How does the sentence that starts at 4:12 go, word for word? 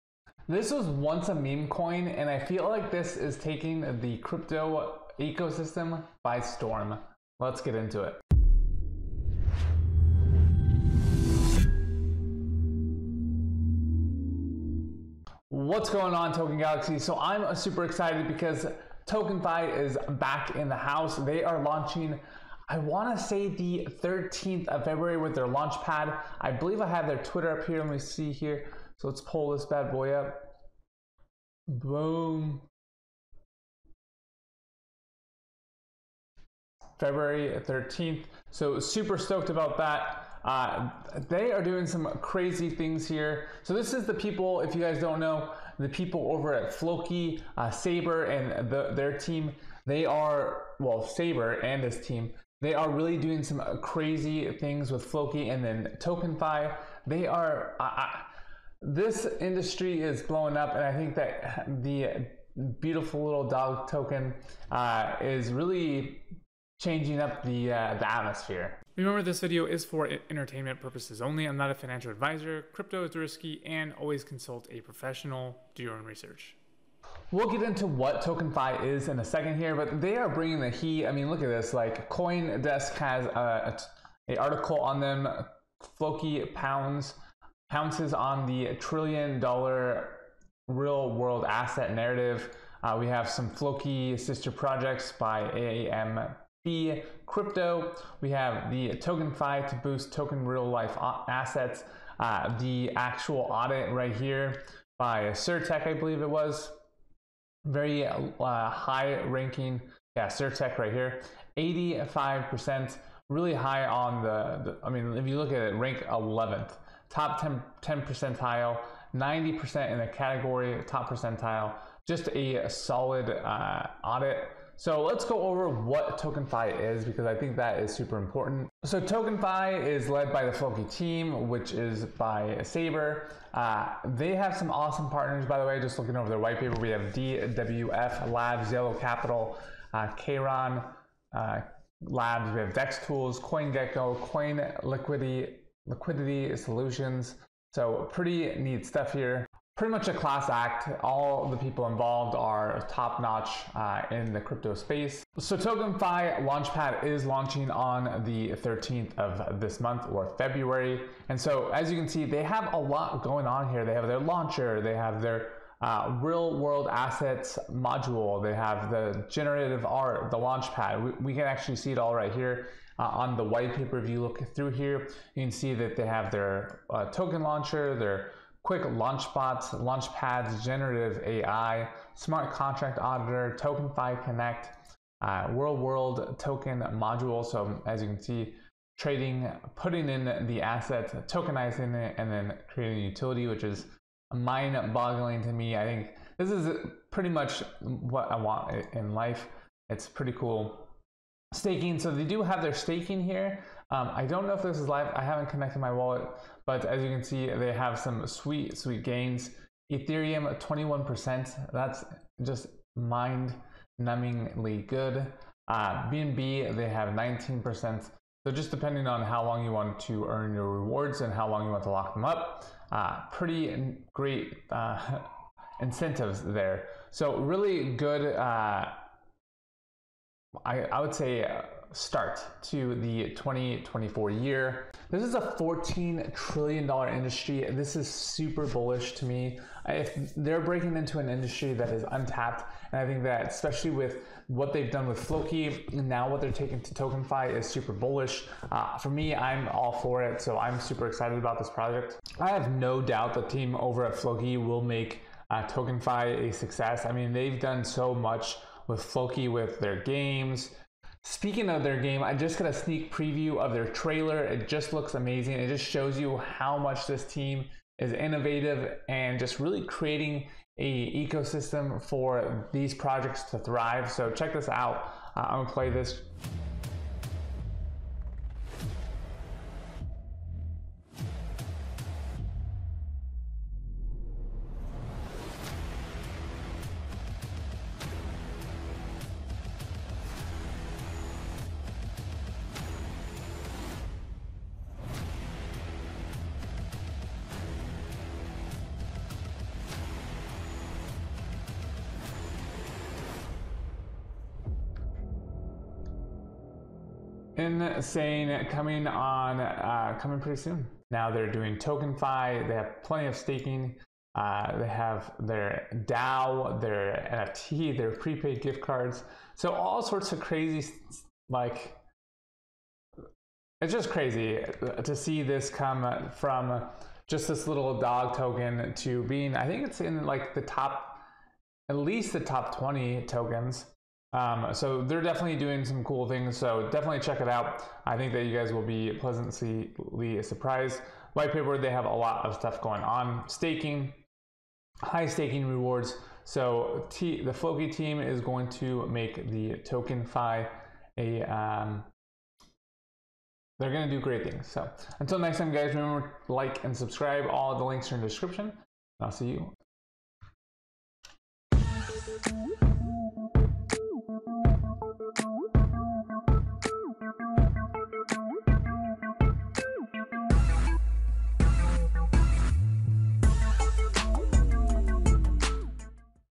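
I have no doubt the team over at Floki will make uh, TokenFi a success.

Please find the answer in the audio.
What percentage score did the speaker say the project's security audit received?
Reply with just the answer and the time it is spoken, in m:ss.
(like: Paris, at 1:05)
85%, at 1:51.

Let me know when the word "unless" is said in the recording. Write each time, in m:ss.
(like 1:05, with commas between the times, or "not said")
not said.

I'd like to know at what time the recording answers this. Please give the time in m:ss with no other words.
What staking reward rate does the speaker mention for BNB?
3:37.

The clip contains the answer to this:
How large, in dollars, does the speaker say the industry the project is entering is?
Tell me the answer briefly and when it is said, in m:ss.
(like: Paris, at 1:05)
$14 trillion, at 3:55.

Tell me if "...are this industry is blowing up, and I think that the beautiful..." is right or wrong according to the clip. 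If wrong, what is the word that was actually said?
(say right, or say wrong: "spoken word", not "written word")
right.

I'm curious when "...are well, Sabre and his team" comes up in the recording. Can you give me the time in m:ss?
0:50.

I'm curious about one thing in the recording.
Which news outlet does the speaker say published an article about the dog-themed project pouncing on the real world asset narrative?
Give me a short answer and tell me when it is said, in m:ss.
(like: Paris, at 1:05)
CoinDesk, at 1:22.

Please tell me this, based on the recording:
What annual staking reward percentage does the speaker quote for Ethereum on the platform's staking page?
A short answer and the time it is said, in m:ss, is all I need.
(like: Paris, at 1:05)
21%, at 3:30.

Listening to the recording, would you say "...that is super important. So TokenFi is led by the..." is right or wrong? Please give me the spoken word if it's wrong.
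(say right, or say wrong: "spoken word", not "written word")
right.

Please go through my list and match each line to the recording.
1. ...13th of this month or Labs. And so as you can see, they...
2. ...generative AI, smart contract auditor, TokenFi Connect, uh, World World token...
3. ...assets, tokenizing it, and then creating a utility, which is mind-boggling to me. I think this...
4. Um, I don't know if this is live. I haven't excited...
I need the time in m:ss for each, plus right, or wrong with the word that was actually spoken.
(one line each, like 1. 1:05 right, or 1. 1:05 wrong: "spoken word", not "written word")
1. 2:38 wrong: "February", not "Labs"
2. 3:00 right
3. 3:10 right
4. 3:23 wrong: "connected", not "excited".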